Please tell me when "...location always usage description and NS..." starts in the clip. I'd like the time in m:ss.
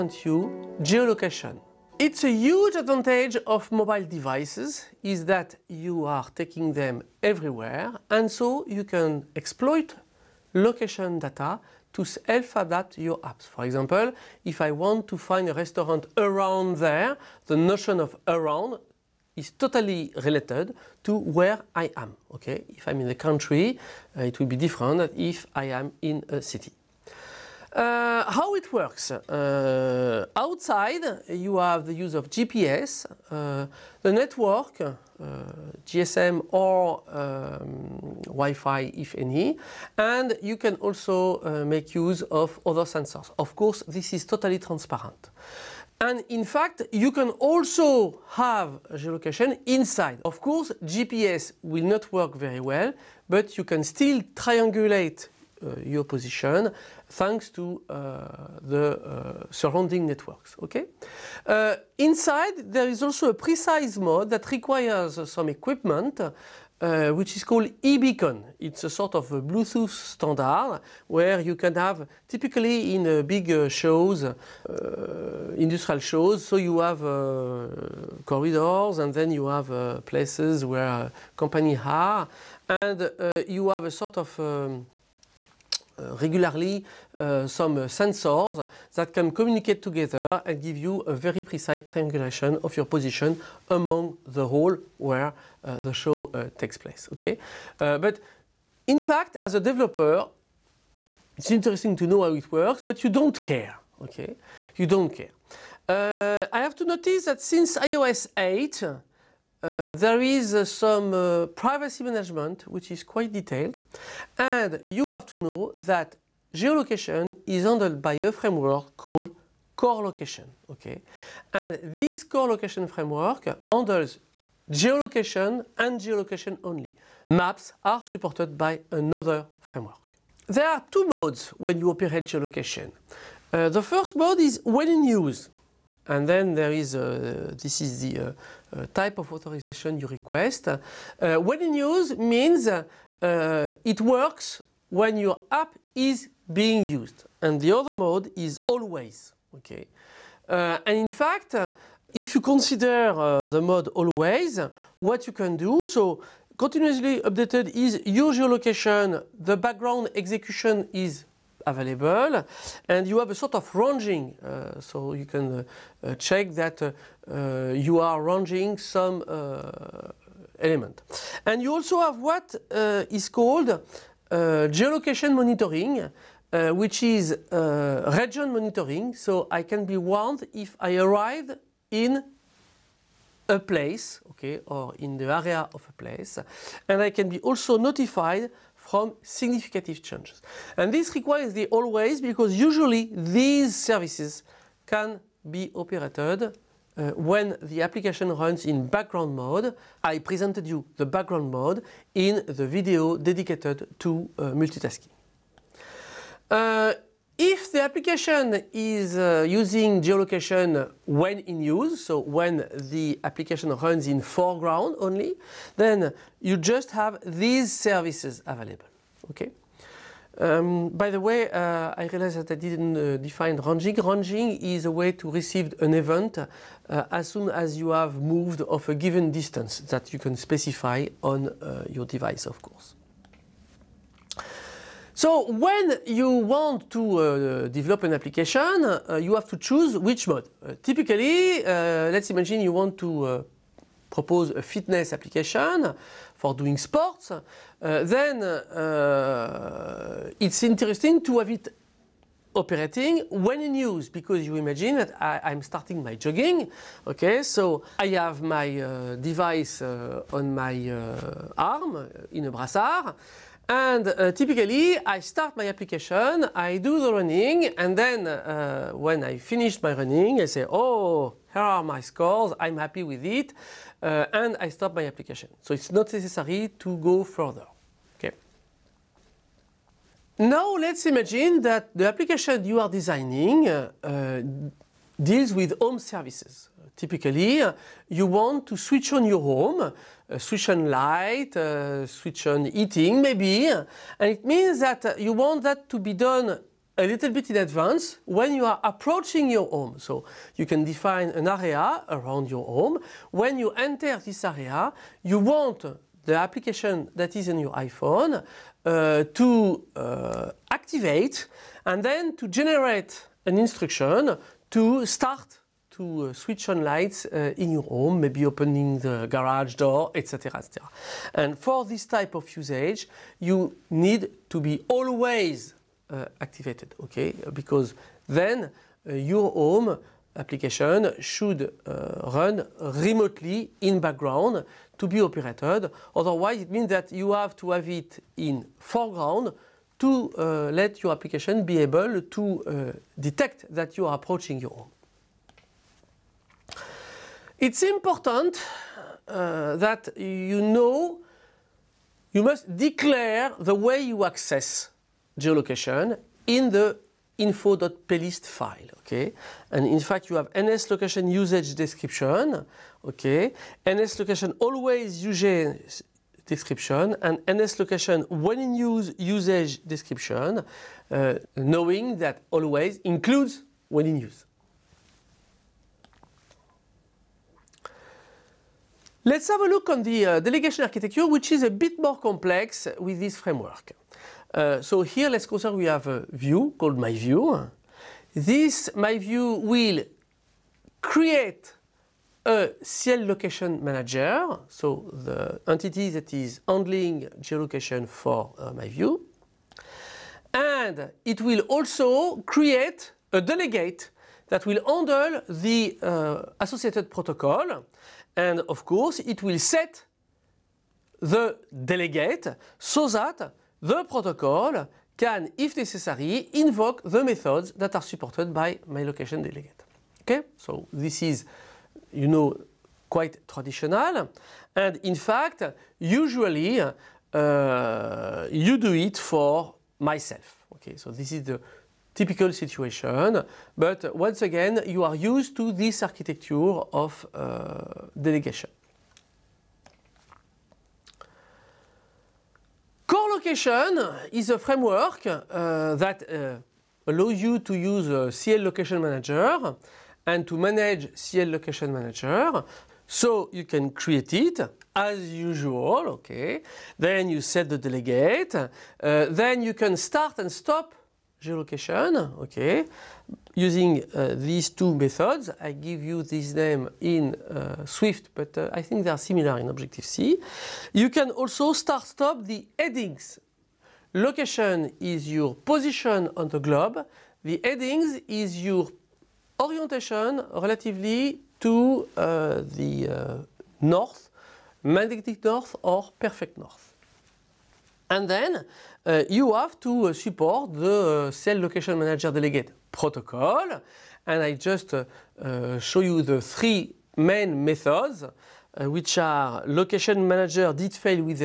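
6:04.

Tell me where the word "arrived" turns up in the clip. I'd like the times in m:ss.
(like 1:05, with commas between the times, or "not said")
3:00.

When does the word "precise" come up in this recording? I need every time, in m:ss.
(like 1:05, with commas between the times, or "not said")
1:03, 1:31.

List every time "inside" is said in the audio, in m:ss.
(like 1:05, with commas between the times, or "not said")
0:49, 1:01.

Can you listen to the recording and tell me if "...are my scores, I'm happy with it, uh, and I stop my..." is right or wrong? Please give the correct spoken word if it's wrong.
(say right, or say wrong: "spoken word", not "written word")
right.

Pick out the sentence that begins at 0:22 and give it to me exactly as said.
Okay, if I'm in the country, uh, it will be different if I am in a city.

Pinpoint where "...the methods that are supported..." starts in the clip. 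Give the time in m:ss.
6:57.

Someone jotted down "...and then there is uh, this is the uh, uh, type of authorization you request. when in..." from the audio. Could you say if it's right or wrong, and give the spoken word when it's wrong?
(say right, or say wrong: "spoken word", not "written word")
right.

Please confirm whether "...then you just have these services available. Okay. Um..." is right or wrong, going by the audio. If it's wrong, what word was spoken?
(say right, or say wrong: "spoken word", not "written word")
right.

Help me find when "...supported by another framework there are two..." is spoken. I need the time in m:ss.
2:08.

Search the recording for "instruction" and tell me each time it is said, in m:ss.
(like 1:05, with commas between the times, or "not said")
5:13.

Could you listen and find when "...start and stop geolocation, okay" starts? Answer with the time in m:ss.
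7:39.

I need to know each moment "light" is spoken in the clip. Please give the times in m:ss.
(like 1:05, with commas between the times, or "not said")
4:50, 5:16.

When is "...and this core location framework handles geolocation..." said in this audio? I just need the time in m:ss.
2:01.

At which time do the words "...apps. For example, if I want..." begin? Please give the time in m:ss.
0:13.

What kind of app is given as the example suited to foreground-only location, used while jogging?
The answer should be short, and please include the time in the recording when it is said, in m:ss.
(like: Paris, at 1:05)
Fitness application, at 4:04.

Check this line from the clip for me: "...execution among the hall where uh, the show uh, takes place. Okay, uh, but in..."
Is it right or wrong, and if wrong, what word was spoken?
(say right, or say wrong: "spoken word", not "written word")
wrong: "position", not "execution".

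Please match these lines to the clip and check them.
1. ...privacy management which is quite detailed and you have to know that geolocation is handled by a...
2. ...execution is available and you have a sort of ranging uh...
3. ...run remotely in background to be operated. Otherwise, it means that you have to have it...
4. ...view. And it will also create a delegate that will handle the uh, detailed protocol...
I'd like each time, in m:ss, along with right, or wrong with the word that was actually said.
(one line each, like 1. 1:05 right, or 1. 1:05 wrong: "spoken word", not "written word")
1. 1:51 right
2. 2:40 right
3. 5:32 right
4. 6:38 wrong: "associated", not "detailed".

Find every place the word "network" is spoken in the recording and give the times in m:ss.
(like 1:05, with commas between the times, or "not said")
0:34, 1:00.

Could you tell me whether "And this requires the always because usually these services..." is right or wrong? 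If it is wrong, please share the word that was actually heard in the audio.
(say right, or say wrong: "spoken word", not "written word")
right.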